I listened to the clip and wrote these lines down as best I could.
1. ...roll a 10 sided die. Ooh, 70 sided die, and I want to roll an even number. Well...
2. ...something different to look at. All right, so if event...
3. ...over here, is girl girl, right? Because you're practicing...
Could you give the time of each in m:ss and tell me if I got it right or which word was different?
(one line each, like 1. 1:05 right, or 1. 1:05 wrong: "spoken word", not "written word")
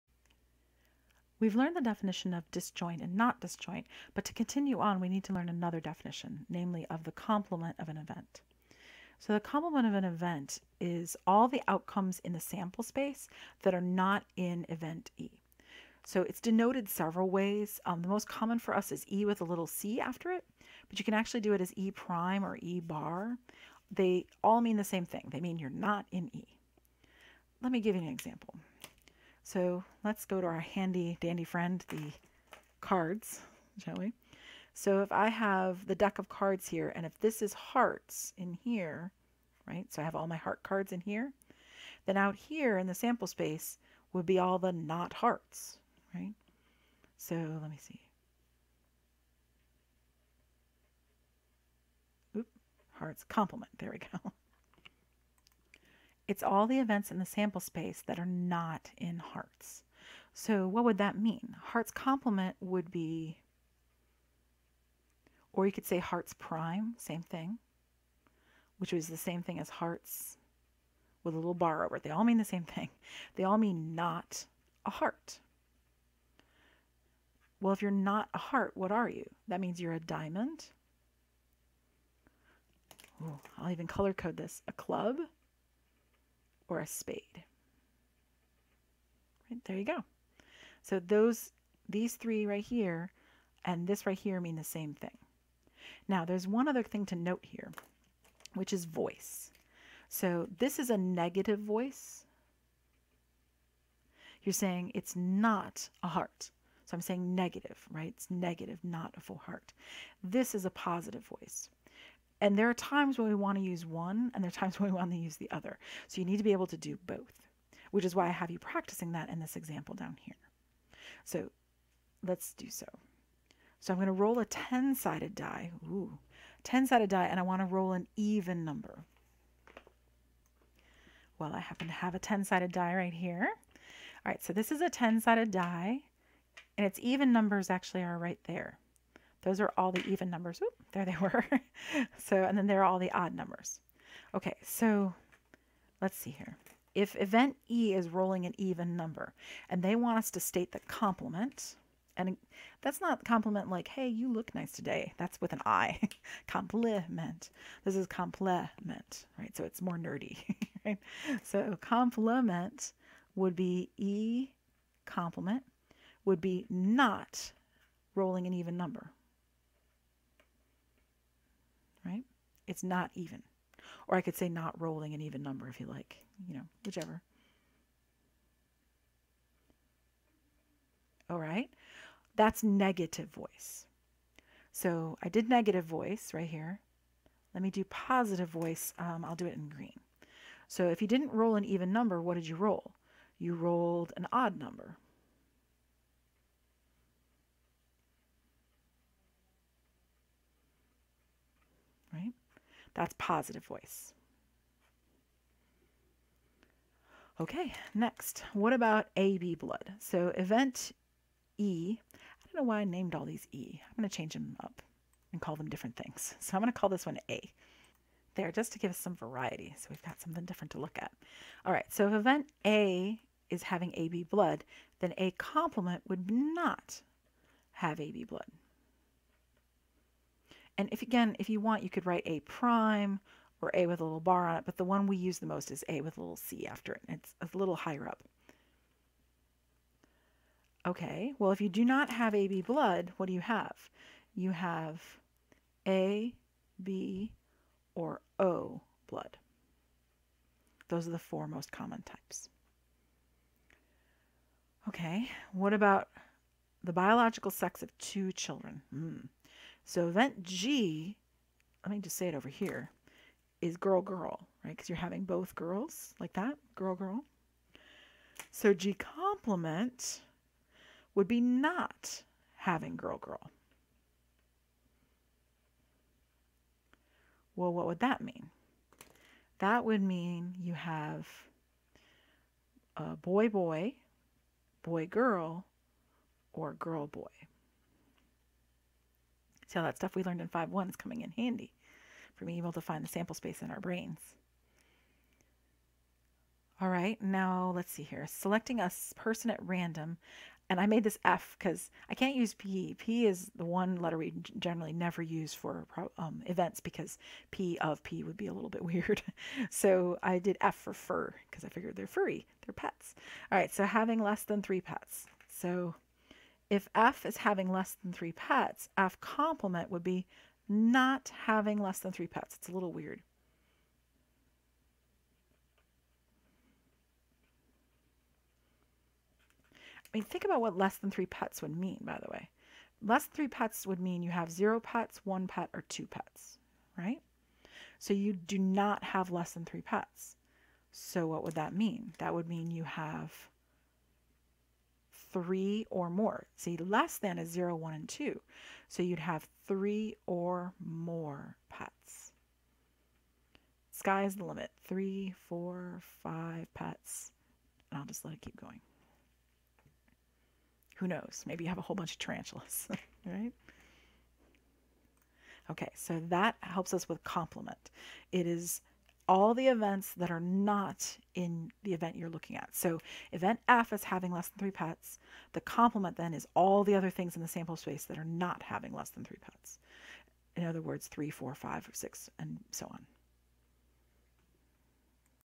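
1. 2:04 wrong: "10", not "70"
2. 3:40 right
3. 4:22 wrong: "having", not "practicing".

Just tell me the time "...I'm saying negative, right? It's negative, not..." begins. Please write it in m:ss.
1:46.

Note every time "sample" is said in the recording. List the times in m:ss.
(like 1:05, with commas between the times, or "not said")
0:12, 0:42, 0:57, 4:53, 6:17.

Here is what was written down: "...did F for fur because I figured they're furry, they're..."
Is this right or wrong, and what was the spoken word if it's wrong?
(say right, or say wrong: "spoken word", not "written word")
right.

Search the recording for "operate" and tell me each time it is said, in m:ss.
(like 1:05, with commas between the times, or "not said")
not said.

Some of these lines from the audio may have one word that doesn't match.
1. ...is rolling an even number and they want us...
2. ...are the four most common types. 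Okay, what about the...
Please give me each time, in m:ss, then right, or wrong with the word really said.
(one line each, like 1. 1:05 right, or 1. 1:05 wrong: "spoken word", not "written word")
1. 2:27 right
2. 4:11 right.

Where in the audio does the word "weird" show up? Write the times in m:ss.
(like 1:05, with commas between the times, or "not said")
5:08, 5:22.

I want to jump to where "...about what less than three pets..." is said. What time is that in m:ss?
5:30.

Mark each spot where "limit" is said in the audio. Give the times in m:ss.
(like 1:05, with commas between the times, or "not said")
5:54.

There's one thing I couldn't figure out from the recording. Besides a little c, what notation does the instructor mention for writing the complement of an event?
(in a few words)
E prime.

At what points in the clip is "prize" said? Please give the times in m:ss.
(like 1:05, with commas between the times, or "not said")
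not said.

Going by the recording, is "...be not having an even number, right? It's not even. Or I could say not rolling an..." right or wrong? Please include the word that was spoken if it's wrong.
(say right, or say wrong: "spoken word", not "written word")
wrong: "rolling", not "having".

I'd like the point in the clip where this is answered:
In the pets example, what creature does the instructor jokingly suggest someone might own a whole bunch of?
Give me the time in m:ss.
6:02.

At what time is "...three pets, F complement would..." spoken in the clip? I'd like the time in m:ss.
5:18.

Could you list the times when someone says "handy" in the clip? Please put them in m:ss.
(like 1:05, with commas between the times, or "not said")
0:30, 4:51.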